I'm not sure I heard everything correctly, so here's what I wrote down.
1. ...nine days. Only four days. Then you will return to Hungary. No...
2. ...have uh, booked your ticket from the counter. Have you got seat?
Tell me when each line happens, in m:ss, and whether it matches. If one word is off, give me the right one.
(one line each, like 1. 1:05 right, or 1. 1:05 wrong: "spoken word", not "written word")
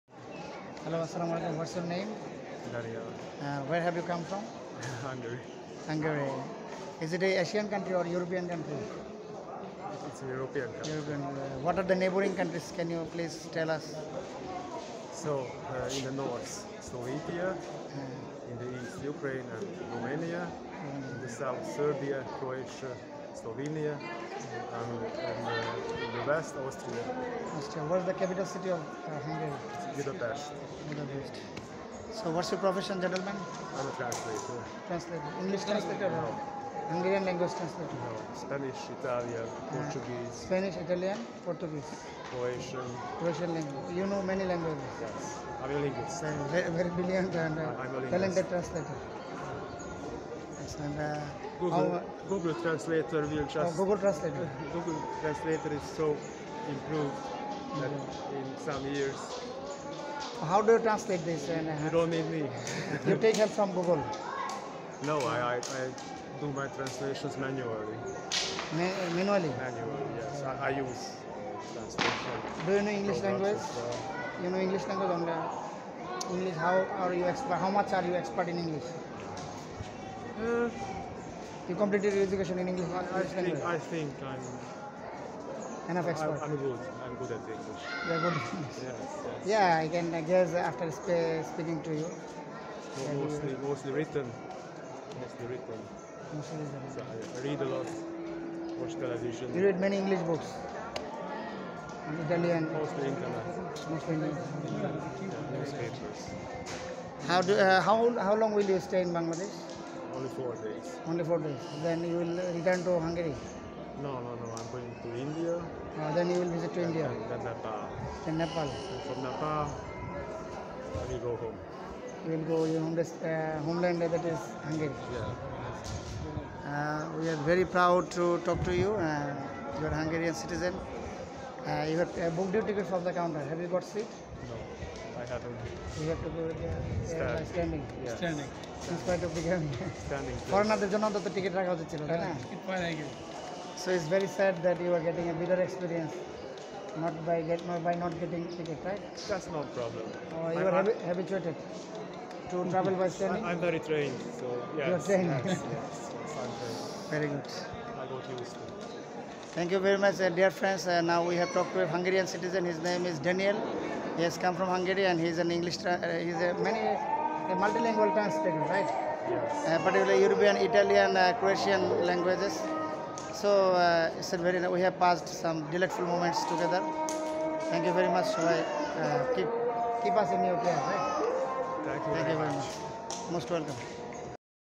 1. 1:50 wrong: "four", not "nine"
2. 2:11 right.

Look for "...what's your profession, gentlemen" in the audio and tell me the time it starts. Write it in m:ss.
0:32.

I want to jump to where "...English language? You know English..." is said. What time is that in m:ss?
1:12.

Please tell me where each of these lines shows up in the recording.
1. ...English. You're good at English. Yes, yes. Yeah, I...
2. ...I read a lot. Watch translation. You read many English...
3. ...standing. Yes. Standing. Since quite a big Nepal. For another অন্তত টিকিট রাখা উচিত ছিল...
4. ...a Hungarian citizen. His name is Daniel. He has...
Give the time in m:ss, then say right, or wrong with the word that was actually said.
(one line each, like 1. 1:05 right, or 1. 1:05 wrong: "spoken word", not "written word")
1. 1:27 right
2. 1:37 wrong: "television", not "translation"
3. 2:17 wrong: "Standing", not "Nepal"
4. 2:41 right.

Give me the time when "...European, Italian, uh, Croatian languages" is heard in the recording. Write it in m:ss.
2:50.